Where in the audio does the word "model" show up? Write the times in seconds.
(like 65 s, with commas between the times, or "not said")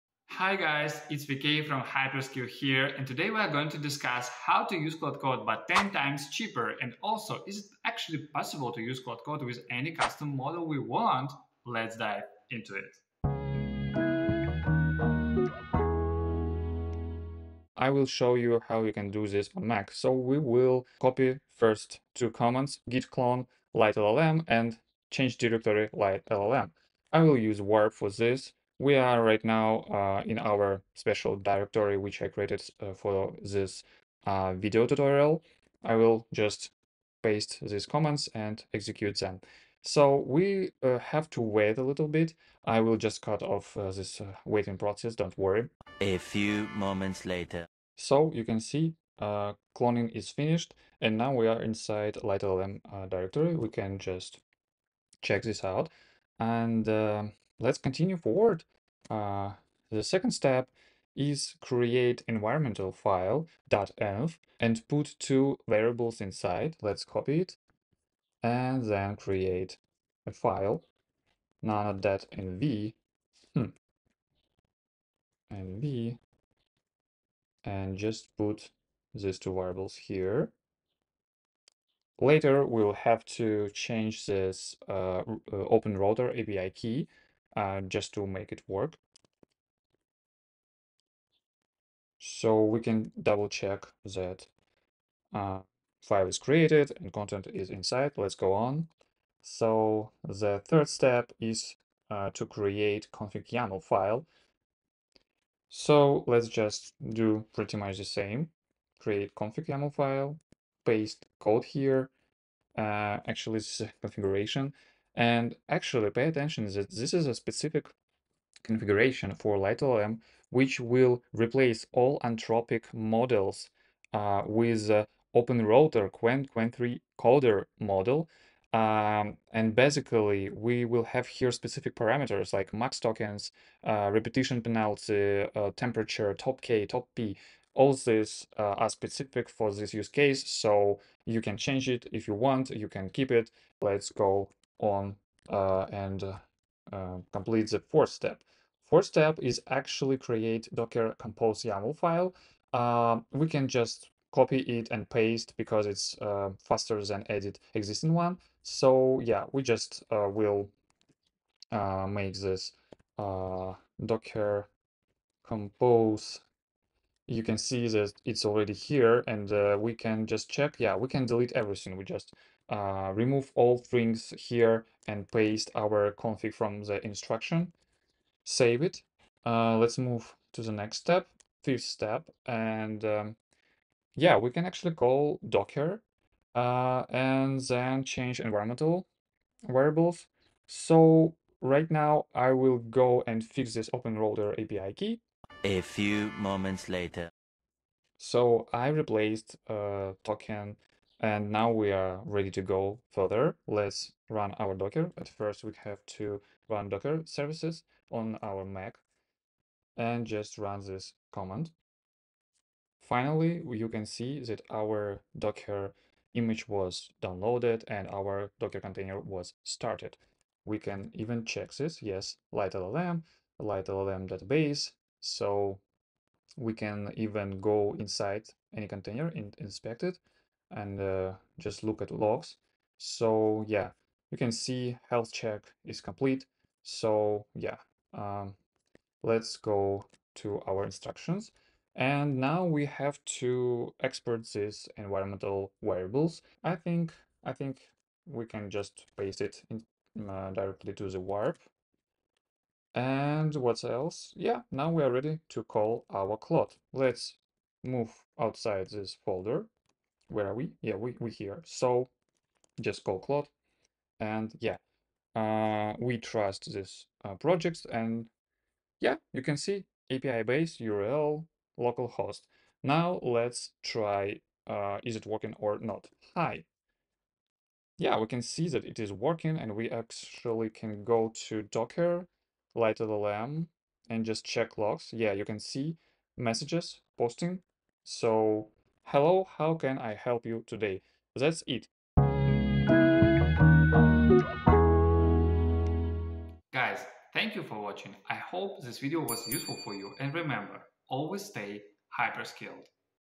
10 s, 122 s, 127 s.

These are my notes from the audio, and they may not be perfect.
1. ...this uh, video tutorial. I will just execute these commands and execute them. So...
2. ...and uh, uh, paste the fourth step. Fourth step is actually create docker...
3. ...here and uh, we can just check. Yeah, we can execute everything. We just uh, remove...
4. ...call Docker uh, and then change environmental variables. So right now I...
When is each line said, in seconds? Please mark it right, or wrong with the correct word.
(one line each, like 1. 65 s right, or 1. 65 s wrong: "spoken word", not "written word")
1. 33 s wrong: "paste", not "execute"
2. 145 s wrong: "complete", not "paste"
3. 168 s wrong: "delete", not "execute"
4. 184 s right.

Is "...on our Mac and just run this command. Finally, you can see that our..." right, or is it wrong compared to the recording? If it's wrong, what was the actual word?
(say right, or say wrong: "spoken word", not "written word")
right.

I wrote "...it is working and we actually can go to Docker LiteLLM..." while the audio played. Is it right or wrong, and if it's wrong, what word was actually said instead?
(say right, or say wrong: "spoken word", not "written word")
right.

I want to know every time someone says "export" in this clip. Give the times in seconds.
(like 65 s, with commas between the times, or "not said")
243 s.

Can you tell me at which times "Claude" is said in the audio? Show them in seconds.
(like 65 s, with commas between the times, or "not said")
4 s, 9 s, 256 s, 263 s.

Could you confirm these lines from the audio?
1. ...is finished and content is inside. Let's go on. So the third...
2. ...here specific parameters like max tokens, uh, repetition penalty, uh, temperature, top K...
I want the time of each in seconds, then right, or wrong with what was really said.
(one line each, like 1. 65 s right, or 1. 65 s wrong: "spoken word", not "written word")
1. 96 s wrong: "created", not "finished"
2. 131 s right.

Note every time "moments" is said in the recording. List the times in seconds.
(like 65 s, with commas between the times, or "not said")
46 s, 196 s.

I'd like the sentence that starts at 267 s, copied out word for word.
And yeah, you can see API base, URL, localhost.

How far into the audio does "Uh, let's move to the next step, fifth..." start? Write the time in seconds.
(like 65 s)
179 s.